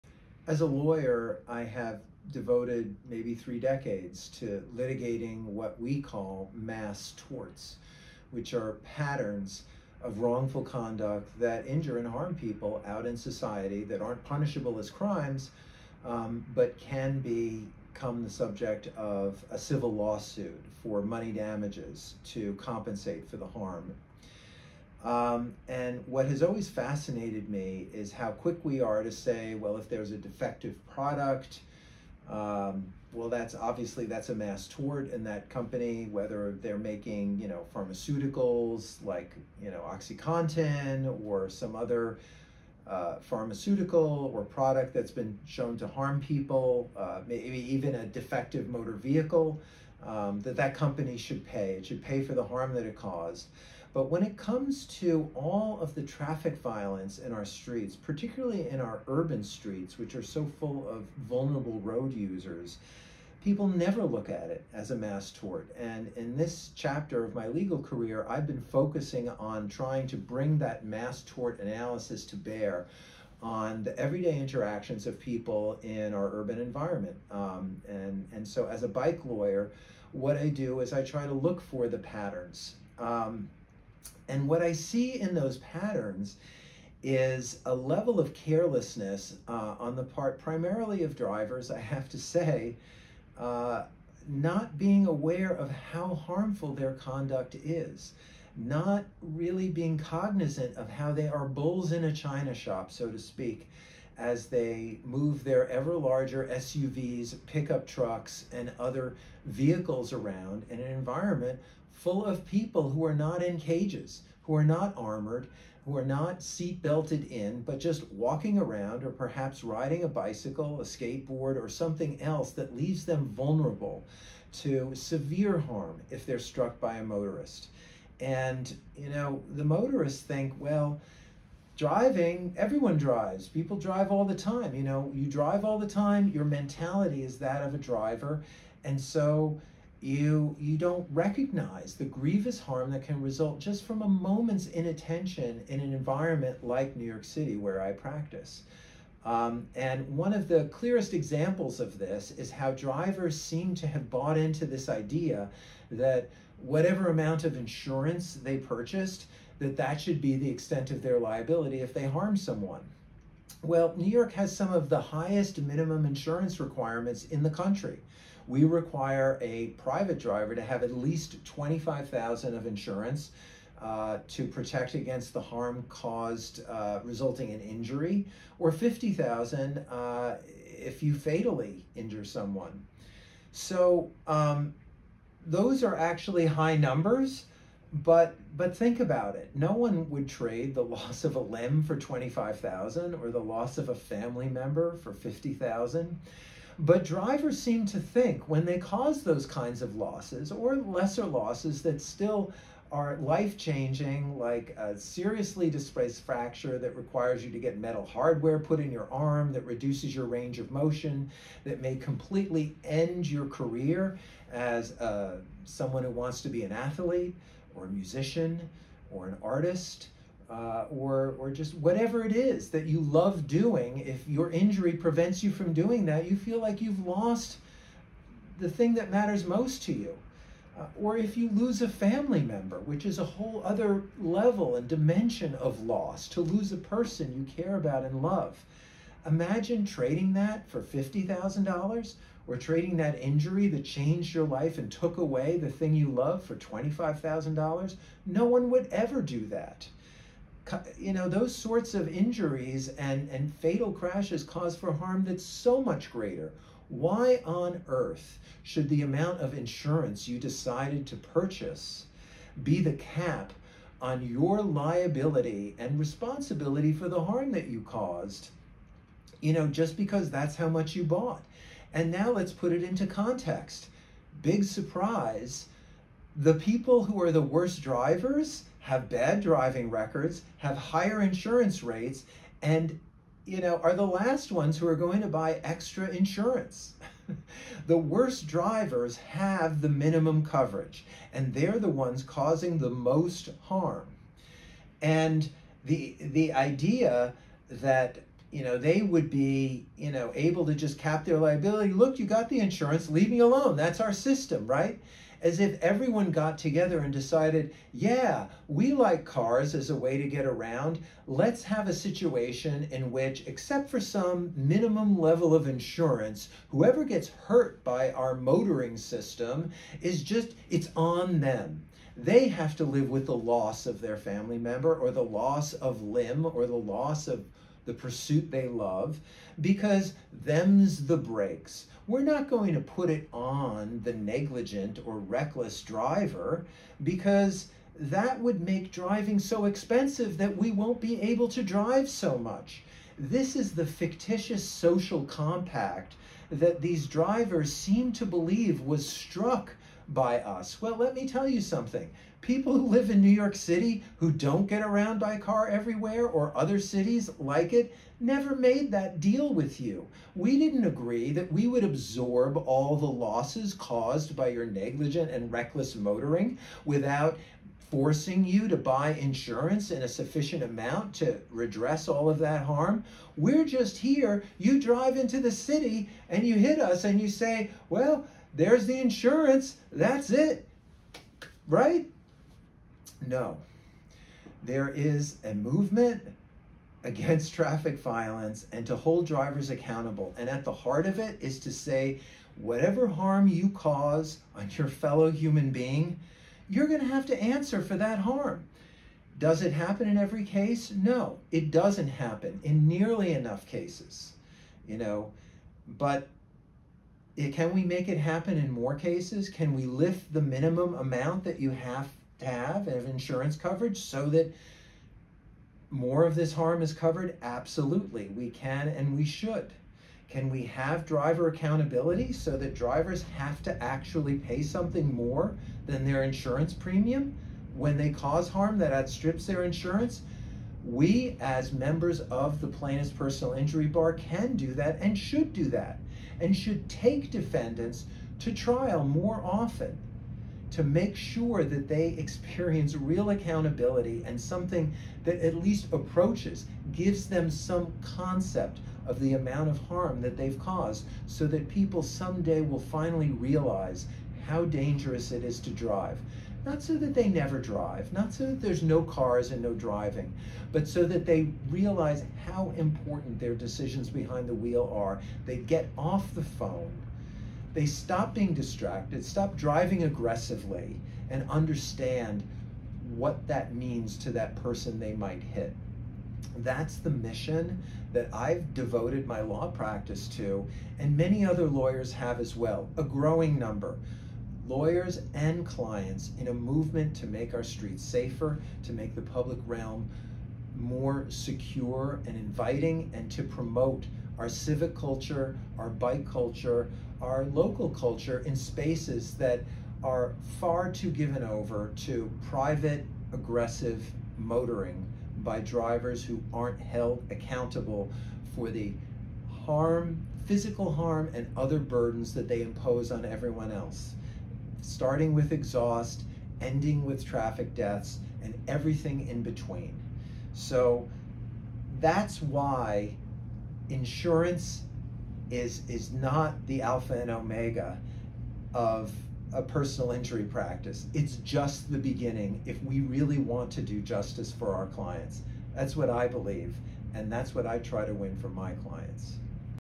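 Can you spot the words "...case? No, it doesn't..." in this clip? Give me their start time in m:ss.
6:40.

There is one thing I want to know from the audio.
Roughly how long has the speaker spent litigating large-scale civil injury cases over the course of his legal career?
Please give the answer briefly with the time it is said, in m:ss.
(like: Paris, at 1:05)
three decades, at 0:03.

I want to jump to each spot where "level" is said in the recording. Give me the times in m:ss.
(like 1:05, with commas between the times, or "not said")
1:27, 3:54, 5:15.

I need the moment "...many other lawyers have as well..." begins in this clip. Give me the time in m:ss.
8:01.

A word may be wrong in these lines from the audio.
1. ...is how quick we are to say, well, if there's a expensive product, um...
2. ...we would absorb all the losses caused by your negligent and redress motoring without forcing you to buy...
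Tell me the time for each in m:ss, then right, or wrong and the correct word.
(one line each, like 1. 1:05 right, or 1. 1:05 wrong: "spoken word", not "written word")
1. 0:27 wrong: "defective", not "expensive"
2. 6:01 wrong: "reckless", not "redress".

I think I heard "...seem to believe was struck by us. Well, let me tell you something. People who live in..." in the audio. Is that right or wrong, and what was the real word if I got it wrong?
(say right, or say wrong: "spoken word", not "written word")
right.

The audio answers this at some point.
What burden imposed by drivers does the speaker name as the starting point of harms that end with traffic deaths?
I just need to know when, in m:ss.
8:35.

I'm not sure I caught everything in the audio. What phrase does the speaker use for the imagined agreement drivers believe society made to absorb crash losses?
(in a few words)
fictitious social compact.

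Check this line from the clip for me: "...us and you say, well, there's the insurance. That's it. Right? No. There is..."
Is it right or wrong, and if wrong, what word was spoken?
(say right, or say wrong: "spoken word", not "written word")
right.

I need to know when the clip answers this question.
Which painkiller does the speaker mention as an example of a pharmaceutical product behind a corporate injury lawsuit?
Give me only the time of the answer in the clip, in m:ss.
0:39.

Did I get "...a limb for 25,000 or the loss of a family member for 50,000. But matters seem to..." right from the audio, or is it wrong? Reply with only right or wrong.
wrong.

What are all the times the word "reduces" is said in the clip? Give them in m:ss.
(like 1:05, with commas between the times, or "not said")
3:29.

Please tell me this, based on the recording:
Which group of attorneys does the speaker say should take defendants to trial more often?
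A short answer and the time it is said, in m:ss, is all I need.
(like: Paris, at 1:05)
plaintiff's personal injury bar, at 7:12.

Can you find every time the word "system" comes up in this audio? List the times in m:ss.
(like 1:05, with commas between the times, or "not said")
5:04, 5:18.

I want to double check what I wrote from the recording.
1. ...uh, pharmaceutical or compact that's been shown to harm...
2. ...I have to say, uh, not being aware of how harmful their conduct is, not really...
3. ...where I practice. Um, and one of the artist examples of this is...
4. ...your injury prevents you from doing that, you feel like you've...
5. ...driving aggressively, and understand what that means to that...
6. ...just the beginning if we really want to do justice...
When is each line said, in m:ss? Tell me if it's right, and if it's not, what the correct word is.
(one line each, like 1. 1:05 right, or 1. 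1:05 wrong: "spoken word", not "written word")
1. 0:42 wrong: "product", not "compact"
2. 1:31 right
3. 2:27 wrong: "clearest", not "artist"
4. 3:44 right
5. 7:49 right
6. 8:51 right.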